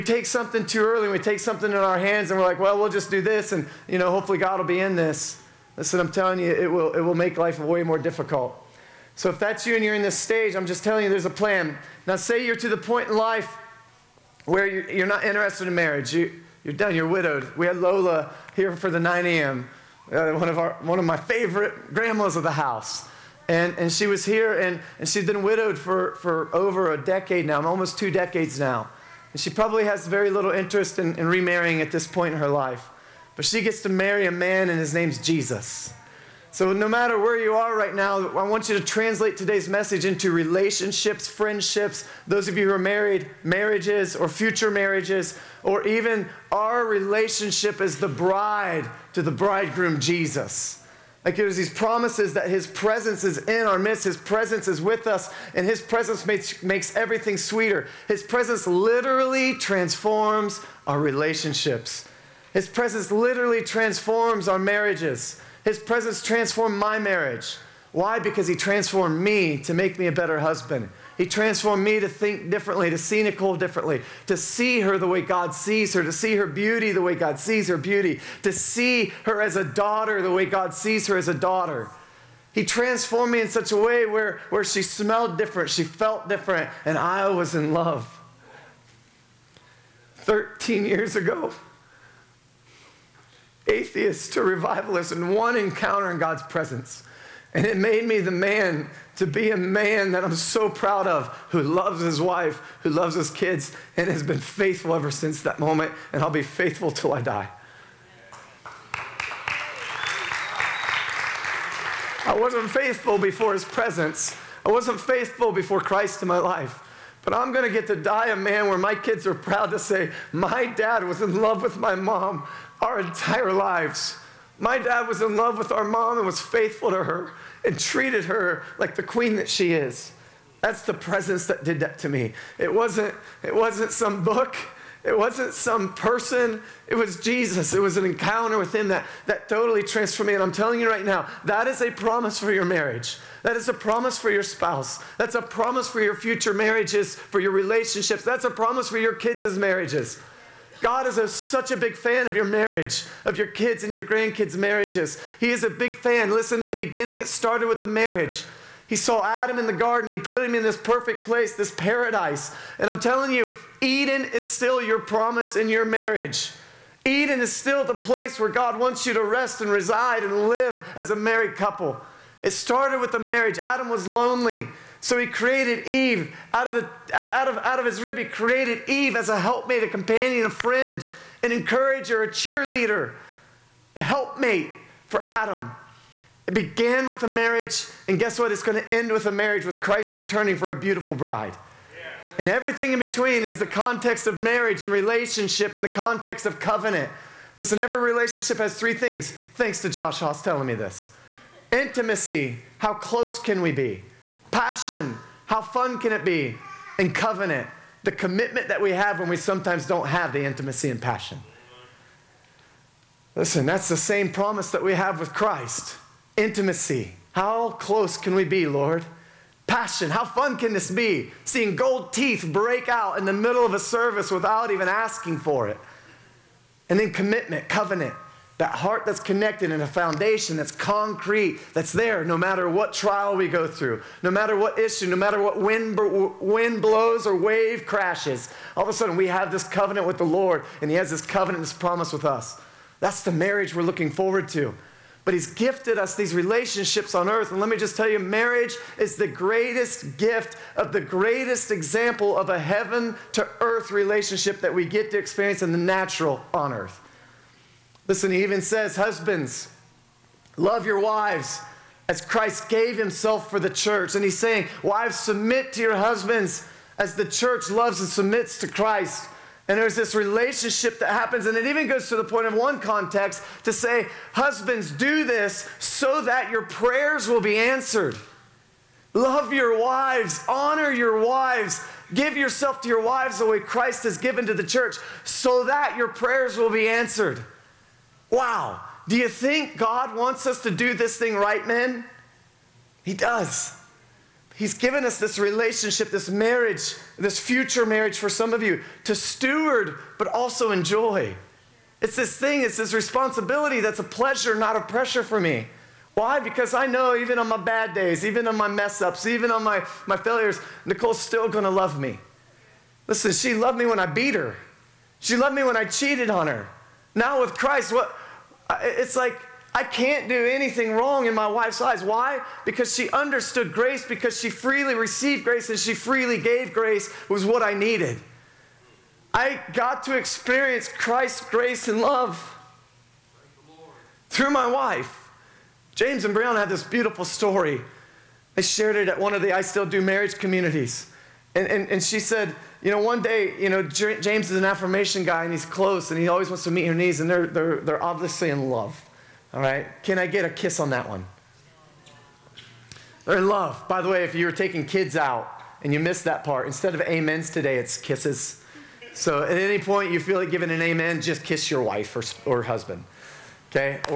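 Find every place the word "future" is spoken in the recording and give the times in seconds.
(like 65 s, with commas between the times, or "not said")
44 s, 146 s, 297 s.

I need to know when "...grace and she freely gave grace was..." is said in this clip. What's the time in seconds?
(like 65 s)
325 s.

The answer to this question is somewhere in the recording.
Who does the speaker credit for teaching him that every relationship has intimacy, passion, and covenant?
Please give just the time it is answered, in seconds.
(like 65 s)
199 s.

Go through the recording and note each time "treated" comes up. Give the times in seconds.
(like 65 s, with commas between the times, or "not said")
127 s.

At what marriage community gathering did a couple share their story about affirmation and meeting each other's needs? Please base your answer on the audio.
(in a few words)
I Still Do.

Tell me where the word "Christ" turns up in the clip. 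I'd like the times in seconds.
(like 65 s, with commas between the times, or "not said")
115 s, 189 s, 215 s, 262 s, 268 s, 283 s, 317 s, 330 s.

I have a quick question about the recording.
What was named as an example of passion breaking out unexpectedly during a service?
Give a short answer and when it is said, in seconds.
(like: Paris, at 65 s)
Gold teeth, at 221 s.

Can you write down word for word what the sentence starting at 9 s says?
So if that's you and you're in this stage, I'm just telling you there's a plan.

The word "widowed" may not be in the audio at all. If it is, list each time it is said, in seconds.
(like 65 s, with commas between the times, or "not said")
17 s, 25 s.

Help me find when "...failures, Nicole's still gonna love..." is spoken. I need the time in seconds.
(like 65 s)
310 s.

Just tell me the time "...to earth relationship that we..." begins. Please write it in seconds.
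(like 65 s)
253 s.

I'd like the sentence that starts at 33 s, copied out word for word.
But she gets to marry a man, and his name's Jesus.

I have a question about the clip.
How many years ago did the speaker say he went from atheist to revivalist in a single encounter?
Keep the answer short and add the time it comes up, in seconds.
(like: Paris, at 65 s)
13, at 90 s.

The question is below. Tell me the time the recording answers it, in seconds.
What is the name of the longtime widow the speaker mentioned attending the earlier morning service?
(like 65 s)
17 s.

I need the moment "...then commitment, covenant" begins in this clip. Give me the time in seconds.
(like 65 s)
226 s.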